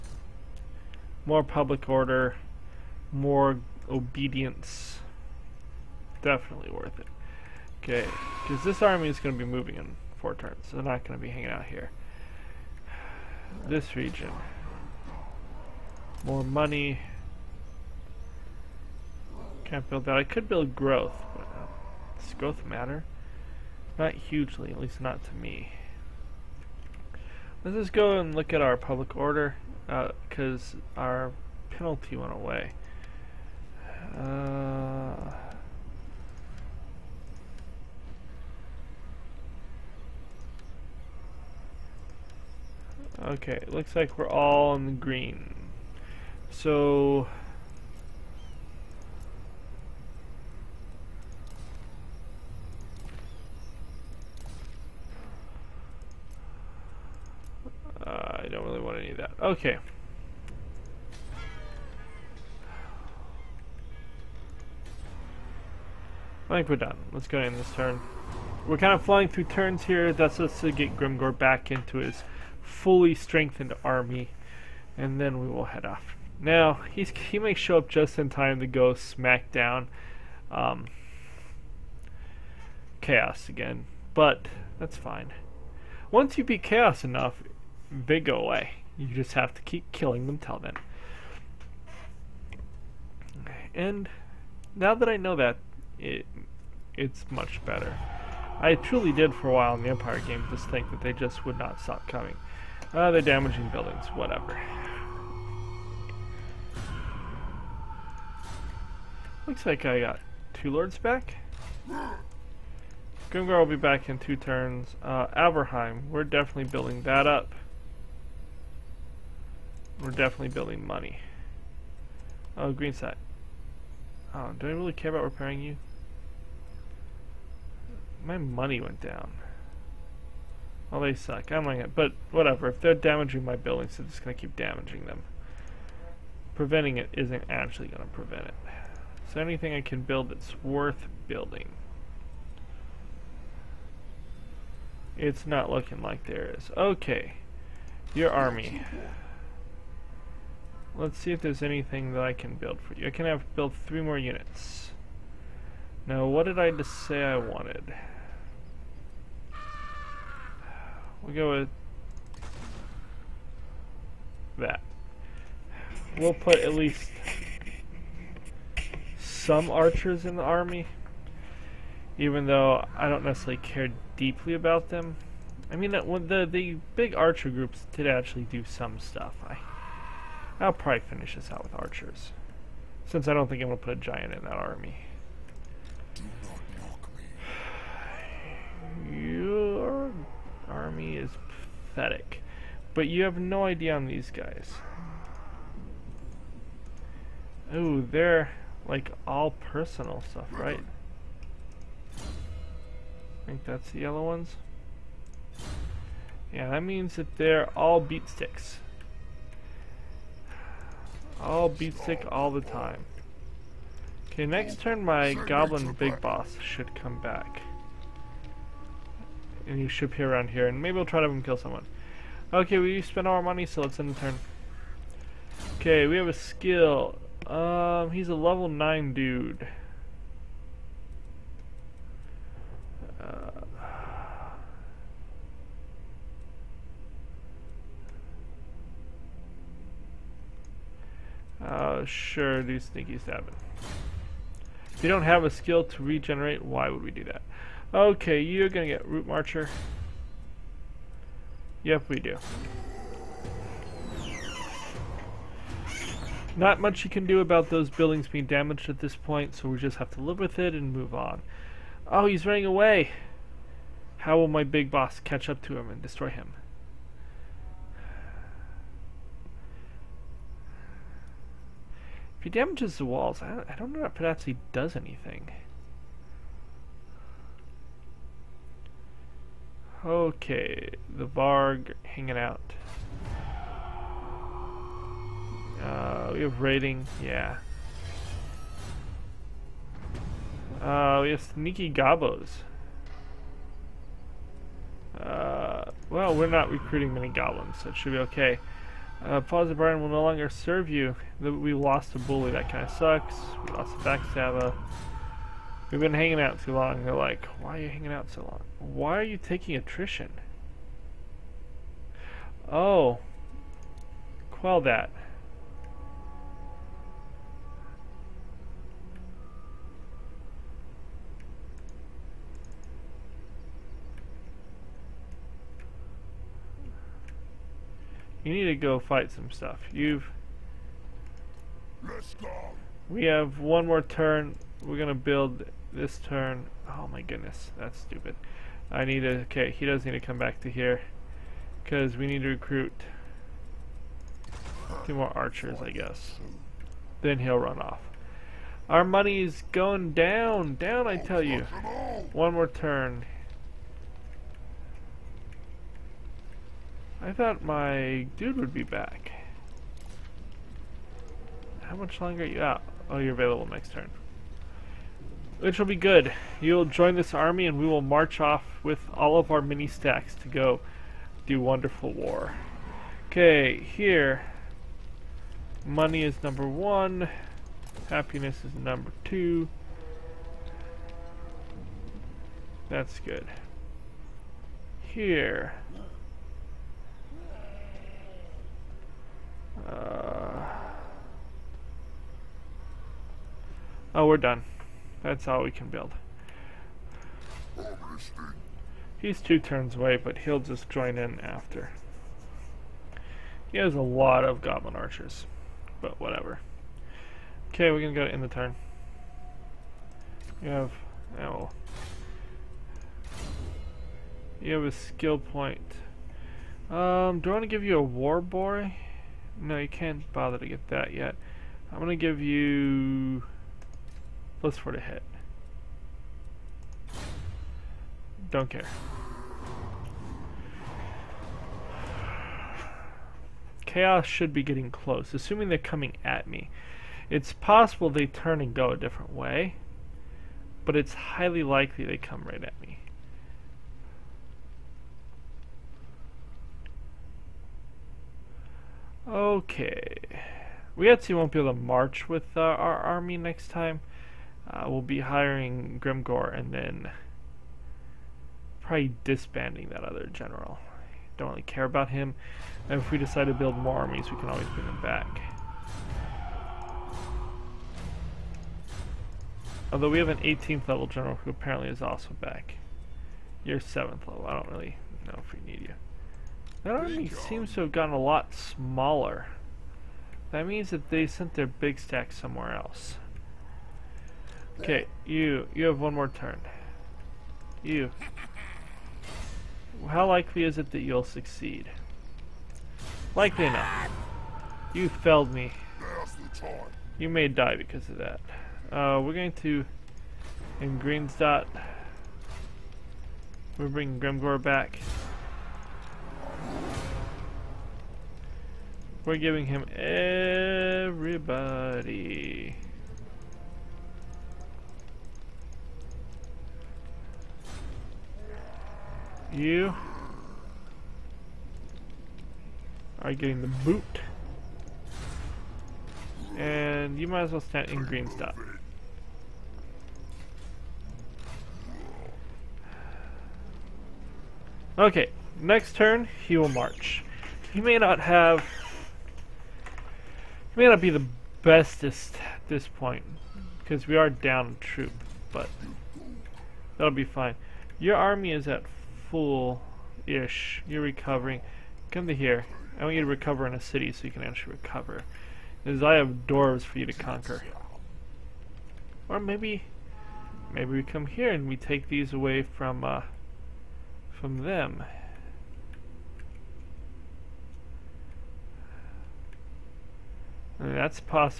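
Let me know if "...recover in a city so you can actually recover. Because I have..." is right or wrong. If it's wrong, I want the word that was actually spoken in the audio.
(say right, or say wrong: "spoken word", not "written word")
right.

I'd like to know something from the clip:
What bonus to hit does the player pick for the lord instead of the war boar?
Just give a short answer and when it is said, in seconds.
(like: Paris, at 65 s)
Plus 4, at 424 s.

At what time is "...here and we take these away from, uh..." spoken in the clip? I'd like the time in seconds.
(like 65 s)
561 s.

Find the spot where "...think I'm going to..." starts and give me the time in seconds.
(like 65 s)
183 s.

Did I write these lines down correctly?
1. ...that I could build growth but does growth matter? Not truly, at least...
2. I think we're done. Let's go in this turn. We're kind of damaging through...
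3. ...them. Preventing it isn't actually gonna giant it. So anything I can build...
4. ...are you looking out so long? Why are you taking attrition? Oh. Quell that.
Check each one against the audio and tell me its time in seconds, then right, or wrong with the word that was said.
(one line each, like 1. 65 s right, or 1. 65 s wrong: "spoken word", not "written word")
1. 20 s wrong: "hugely", not "truly"
2. 66 s wrong: "flying", not "damaging"
3. 135 s wrong: "prevent", not "giant"
4. 307 s wrong: "hanging", not "looking".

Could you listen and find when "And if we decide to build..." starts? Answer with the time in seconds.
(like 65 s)
462 s.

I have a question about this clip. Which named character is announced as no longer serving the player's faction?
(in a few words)
Father Brian.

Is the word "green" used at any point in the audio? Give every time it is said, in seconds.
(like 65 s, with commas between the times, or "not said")
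44 s, 122 s, 500 s, 528 s.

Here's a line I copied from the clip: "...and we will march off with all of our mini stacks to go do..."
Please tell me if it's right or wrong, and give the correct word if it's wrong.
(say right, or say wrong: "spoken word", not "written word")
right.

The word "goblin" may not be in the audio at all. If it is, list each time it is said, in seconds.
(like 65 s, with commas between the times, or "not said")
215 s, 297 s, 404 s.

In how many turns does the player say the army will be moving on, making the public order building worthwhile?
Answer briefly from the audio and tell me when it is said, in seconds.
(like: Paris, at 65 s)
4, at 10 s.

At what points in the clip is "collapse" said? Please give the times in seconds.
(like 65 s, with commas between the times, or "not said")
not said.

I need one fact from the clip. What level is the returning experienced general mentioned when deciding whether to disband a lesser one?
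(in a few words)
18.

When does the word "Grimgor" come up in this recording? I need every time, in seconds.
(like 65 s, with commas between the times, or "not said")
70 s, 456 s, 504 s.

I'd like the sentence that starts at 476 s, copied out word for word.
That army seems to have gotten a lot smaller.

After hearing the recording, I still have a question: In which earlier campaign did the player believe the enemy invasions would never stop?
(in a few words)
Empire.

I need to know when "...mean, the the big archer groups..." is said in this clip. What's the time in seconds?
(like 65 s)
175 s.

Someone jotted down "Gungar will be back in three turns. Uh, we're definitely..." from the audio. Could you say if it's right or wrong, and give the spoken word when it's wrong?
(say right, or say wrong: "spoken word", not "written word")
wrong: "two", not "three".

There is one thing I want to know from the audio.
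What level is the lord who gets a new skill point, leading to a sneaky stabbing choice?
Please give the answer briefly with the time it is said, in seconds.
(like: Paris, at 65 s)
9, at 228 s.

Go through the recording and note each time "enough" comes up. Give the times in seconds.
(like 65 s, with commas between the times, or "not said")
87 s, 493 s.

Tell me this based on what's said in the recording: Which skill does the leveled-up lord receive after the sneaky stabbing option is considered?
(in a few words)
Route Marcher.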